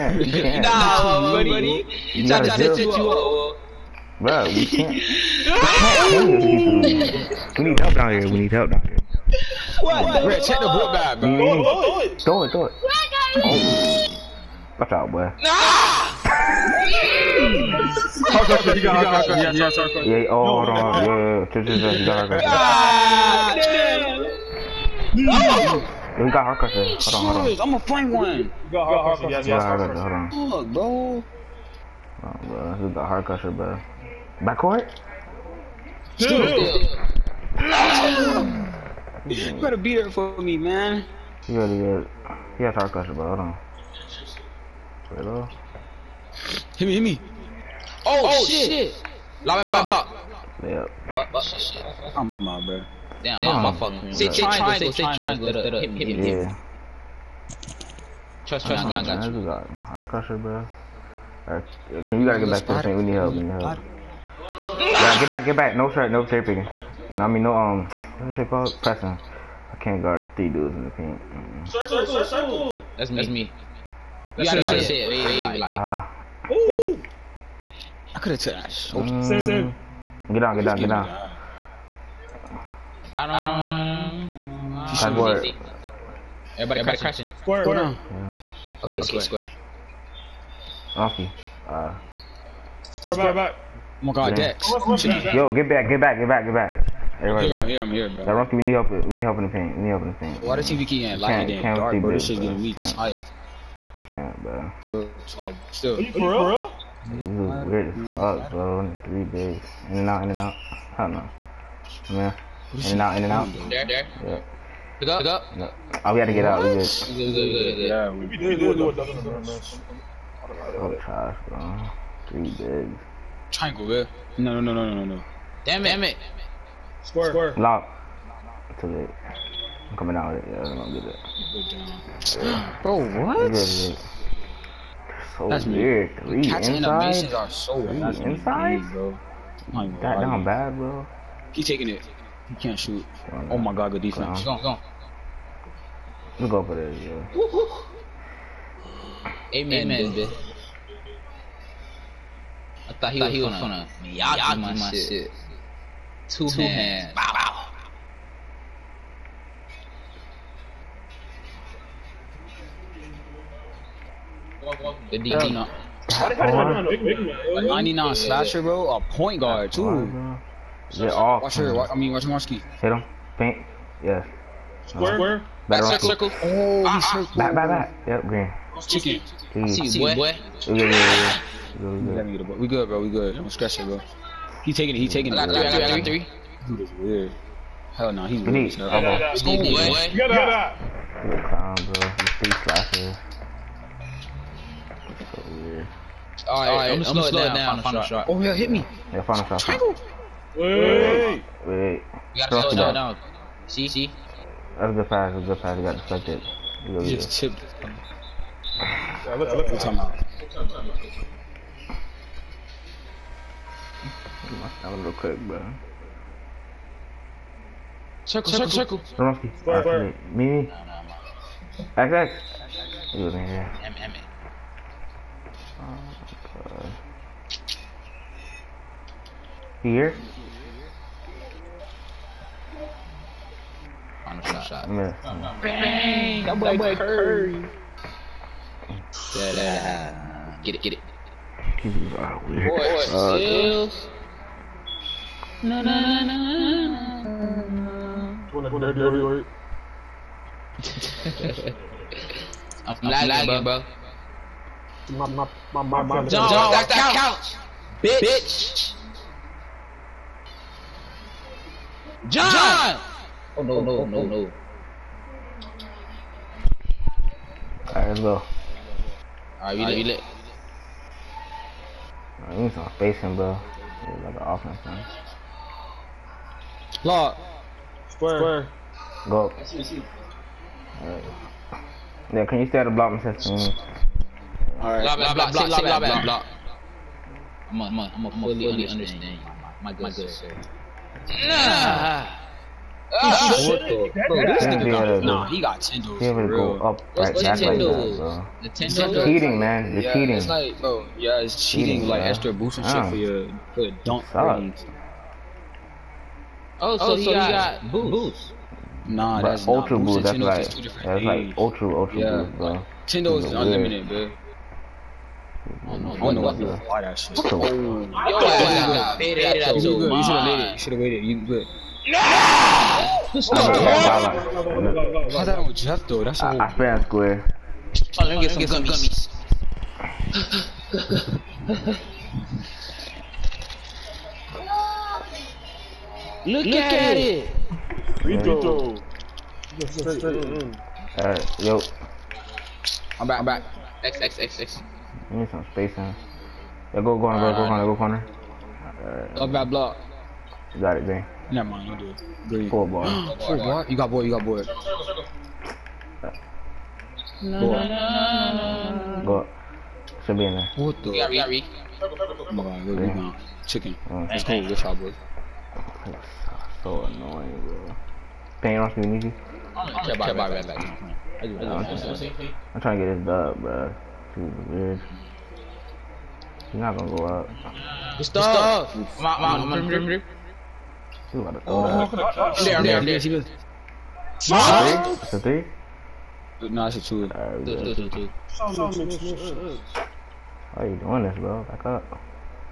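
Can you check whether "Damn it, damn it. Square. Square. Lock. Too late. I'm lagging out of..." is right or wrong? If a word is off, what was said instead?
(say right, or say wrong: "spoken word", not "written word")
wrong: "coming", not "lagging".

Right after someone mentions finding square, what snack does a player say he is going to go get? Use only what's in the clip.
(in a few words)
gummies.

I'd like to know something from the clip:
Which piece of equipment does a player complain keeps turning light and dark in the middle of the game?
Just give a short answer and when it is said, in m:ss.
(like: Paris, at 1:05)
TV, at 1:40.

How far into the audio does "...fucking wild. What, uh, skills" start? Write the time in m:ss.
4:01.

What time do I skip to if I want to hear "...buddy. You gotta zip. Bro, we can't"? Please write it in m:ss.
0:01.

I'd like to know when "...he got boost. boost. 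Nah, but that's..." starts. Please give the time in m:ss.
5:07.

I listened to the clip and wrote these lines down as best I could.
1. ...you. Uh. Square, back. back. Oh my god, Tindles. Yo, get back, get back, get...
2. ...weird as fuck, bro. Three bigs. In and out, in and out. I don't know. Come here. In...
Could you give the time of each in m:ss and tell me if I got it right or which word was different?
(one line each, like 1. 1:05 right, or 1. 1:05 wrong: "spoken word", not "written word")
1. 1:31 wrong: "Dex", not "Tindles"
2. 1:47 right.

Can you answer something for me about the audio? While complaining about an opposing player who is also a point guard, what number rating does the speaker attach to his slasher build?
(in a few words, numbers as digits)
99.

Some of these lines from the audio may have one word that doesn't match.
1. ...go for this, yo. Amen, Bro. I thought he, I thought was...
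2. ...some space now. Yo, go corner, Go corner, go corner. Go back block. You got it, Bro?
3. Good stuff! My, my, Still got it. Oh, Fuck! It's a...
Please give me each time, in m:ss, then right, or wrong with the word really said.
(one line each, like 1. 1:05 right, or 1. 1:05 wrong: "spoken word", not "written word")
1. 2:26 wrong: "Amen", not "Bro"
2. 5:45 wrong: "Zane", not "Bro"
3. 6:18 right.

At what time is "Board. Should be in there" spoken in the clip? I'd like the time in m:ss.
5:59.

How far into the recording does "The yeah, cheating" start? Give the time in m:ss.
4:59.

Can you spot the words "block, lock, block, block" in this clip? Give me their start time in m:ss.
0:49.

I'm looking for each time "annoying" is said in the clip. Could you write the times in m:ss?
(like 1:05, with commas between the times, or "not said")
6:07.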